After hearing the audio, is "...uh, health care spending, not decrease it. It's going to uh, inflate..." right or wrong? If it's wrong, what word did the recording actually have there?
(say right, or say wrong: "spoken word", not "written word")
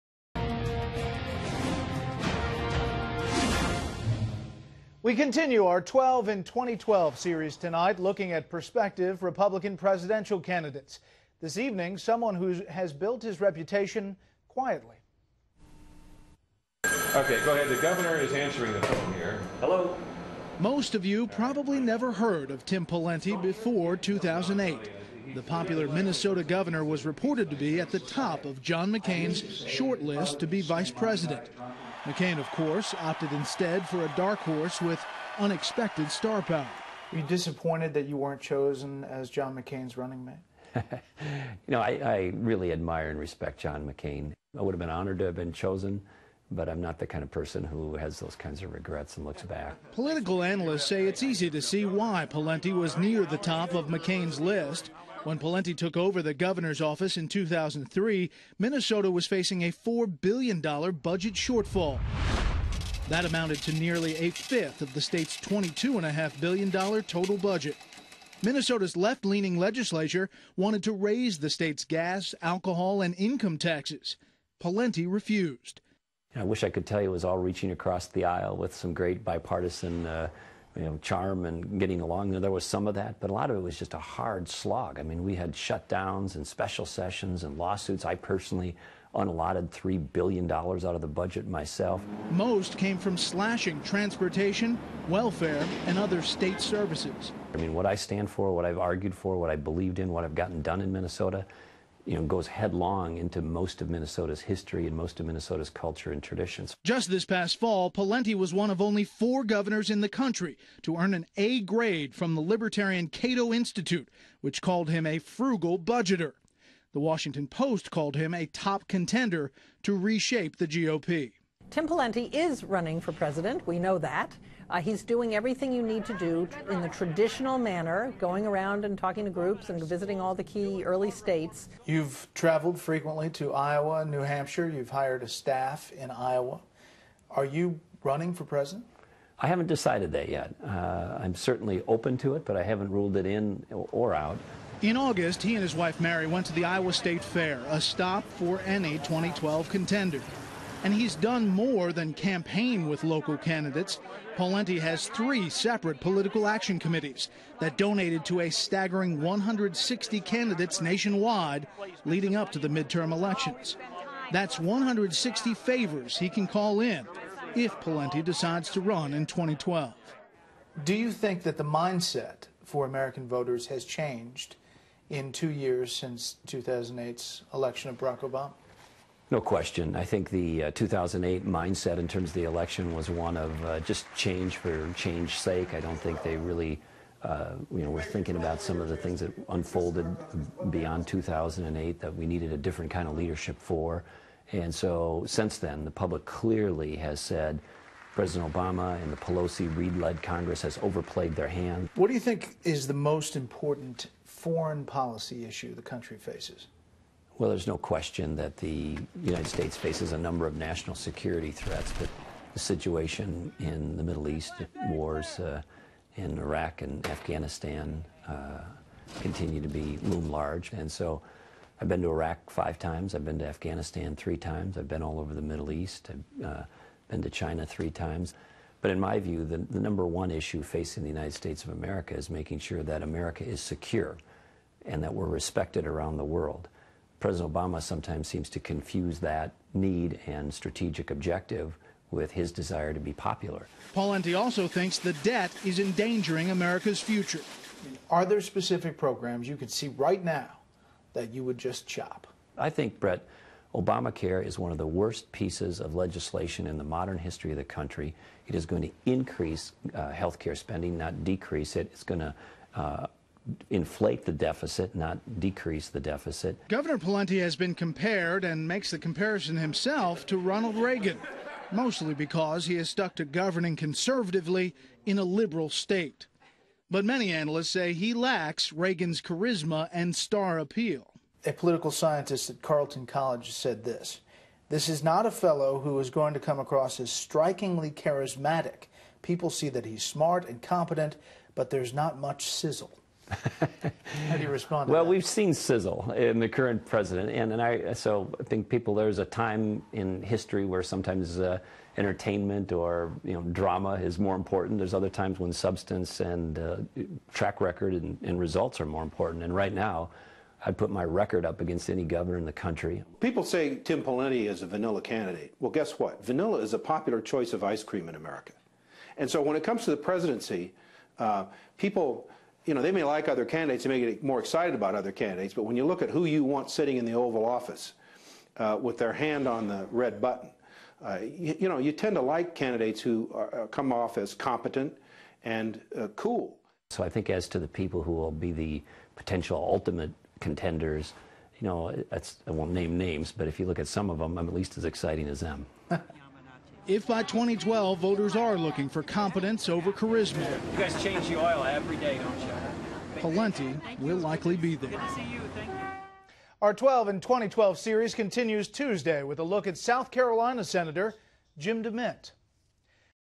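right.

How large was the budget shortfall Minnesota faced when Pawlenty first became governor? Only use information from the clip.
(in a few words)
$4 billion.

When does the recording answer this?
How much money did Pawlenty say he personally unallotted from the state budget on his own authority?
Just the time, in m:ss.
1:29.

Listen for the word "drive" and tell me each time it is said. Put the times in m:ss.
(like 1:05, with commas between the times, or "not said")
not said.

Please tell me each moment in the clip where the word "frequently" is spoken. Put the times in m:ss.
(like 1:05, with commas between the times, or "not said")
2:12.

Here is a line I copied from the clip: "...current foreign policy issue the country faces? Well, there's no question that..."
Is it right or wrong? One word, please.
wrong.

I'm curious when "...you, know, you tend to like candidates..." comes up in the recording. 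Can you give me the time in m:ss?
5:31.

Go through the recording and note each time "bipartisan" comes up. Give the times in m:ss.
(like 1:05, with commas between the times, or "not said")
1:19.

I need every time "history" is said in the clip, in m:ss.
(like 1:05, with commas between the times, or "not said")
1:44, 4:17, 5:00.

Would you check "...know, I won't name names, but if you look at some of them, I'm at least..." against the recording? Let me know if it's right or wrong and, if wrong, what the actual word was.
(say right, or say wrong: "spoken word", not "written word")
right.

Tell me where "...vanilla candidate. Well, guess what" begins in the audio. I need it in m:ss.
5:14.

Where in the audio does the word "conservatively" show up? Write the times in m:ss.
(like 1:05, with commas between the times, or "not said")
4:33.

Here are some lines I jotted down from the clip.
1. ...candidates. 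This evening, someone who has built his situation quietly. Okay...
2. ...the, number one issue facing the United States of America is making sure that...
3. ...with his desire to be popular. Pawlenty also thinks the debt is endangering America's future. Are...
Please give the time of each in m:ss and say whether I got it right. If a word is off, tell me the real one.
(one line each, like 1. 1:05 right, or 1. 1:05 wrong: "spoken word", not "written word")
1. 0:10 wrong: "reputation", not "situation"
2. 3:49 right
3. 4:02 right.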